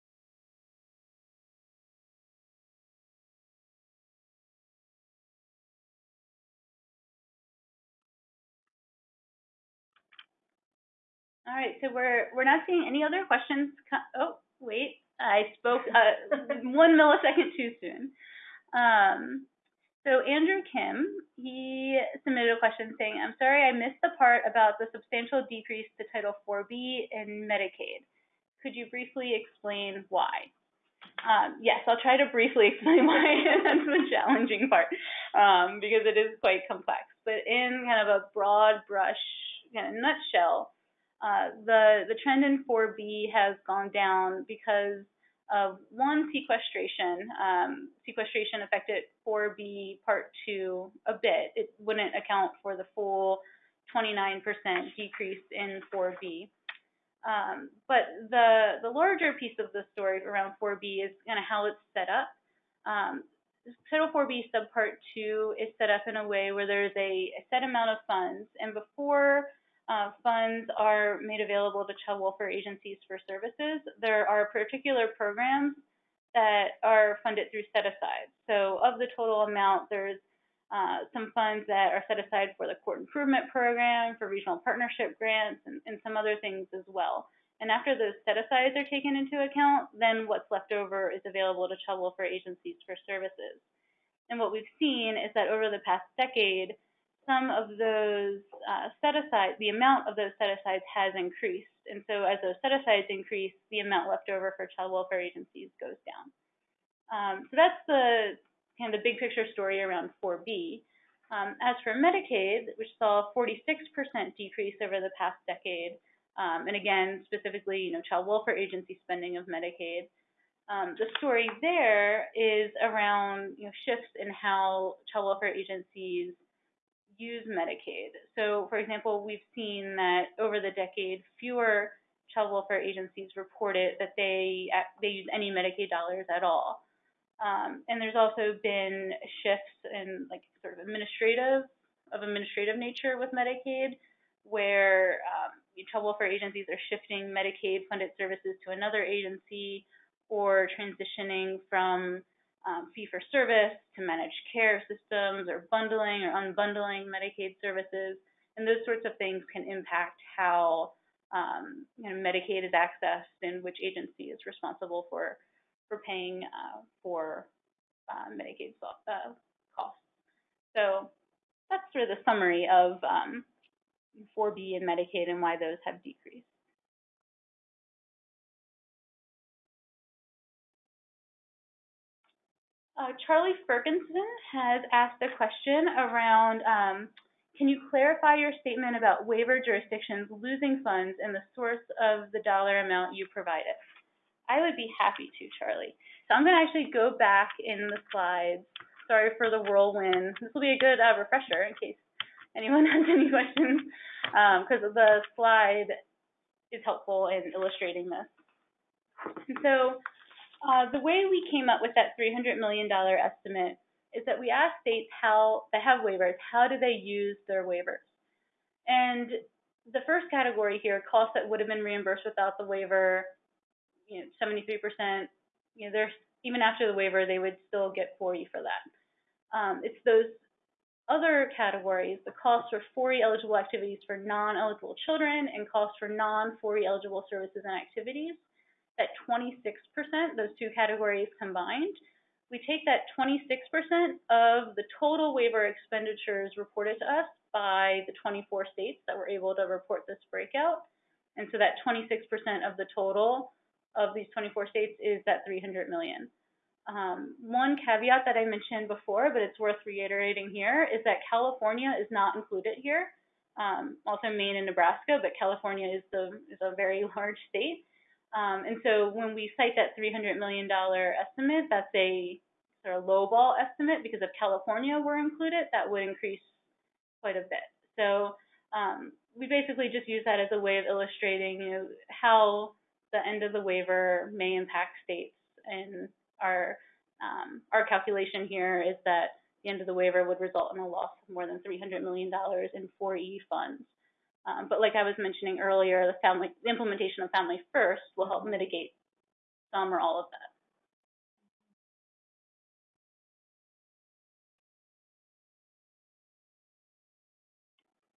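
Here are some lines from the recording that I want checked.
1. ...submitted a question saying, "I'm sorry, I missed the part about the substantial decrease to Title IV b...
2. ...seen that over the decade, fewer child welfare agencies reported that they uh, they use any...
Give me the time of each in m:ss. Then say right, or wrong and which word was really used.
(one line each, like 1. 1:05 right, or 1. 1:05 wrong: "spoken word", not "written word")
1. 0:22 right
2. 2:09 right.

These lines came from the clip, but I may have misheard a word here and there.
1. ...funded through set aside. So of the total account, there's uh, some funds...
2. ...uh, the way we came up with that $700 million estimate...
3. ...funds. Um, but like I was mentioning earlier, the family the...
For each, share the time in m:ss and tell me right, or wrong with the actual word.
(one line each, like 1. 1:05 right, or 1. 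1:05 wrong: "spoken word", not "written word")
1. 1:17 wrong: "amount", not "account"
2. 3:30 wrong: "300", not "700"
3. 4:53 right.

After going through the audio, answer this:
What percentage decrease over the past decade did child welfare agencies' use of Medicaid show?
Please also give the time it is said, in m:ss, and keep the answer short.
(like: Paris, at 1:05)
46%, at 1:53.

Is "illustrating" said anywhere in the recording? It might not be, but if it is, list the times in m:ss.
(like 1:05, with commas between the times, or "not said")
3:27, 4:40.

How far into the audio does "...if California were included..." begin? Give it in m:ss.
4:34.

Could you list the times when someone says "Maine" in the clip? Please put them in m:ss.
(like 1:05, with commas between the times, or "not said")
4:24.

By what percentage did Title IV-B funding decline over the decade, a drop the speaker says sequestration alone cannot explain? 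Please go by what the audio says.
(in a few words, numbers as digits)
29%.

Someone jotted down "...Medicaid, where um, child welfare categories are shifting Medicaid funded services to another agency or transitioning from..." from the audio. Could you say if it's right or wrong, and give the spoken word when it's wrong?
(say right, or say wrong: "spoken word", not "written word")
wrong: "agencies", not "categories".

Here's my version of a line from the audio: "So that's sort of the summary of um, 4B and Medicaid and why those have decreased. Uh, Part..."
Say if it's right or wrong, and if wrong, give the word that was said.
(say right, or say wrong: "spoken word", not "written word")
wrong: "Charlie", not "Part".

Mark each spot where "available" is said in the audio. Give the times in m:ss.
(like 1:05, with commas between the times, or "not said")
1:11, 1:31.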